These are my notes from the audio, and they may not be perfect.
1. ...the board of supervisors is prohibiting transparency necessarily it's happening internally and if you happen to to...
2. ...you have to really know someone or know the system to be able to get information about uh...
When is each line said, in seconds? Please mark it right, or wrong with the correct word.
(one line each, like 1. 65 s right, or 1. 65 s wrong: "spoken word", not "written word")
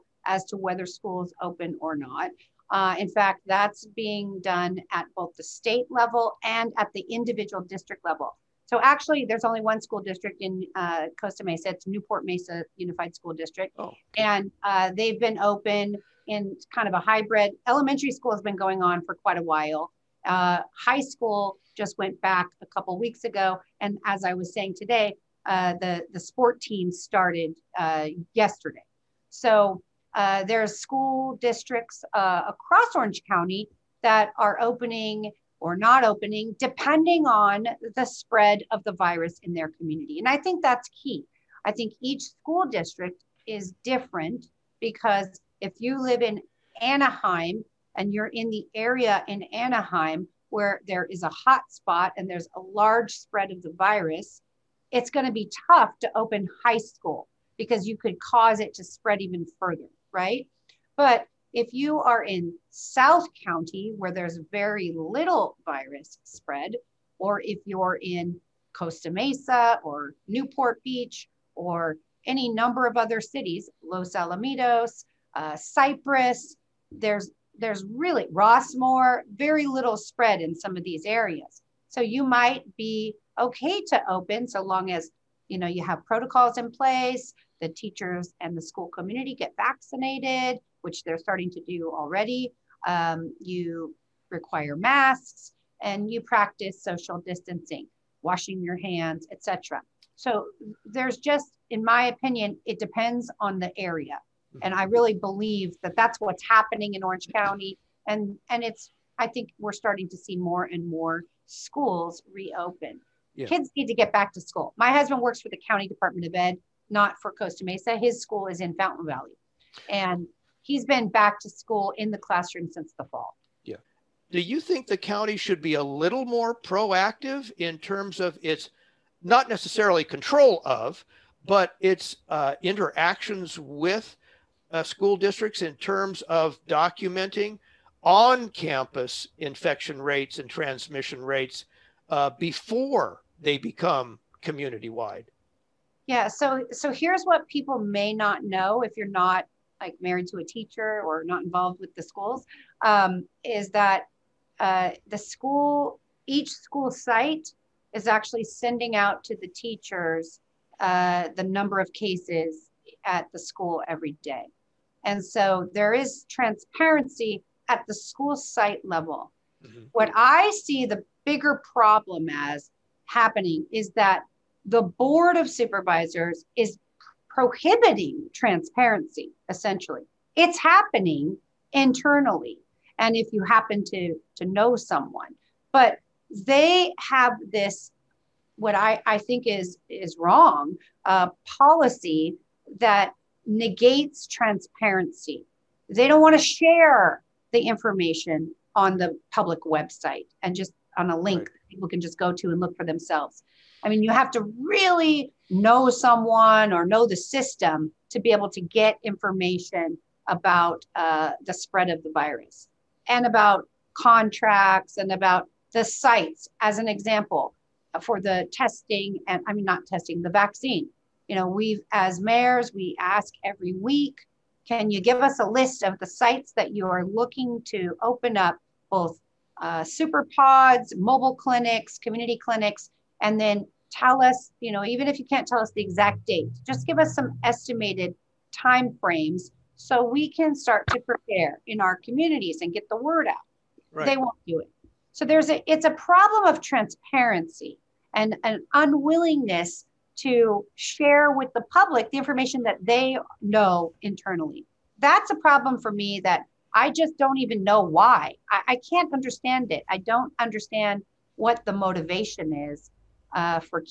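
1. 174 s wrong: "essentially", not "necessarily"
2. 204 s right.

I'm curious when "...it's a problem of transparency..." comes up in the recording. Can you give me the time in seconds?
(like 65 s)
245 s.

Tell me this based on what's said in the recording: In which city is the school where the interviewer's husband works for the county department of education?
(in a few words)
Fountain Valley.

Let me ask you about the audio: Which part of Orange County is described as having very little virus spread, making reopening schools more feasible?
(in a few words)
South County.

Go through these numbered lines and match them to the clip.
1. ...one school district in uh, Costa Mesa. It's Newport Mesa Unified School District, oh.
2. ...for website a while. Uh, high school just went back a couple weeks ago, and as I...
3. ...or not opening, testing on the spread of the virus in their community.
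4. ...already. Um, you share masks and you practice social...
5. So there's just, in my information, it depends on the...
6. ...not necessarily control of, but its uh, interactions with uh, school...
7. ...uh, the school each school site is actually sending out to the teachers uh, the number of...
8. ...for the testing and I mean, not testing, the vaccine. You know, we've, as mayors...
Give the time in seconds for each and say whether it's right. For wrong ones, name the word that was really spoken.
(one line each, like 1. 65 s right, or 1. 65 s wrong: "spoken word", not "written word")
1. 9 s right
2. 19 s wrong: "quite", not "website"
3. 35 s wrong: "depending", not "testing"
4. 91 s wrong: "require", not "share"
5. 100 s wrong: "opinion", not "information"
6. 129 s right
7. 154 s right
8. 217 s right.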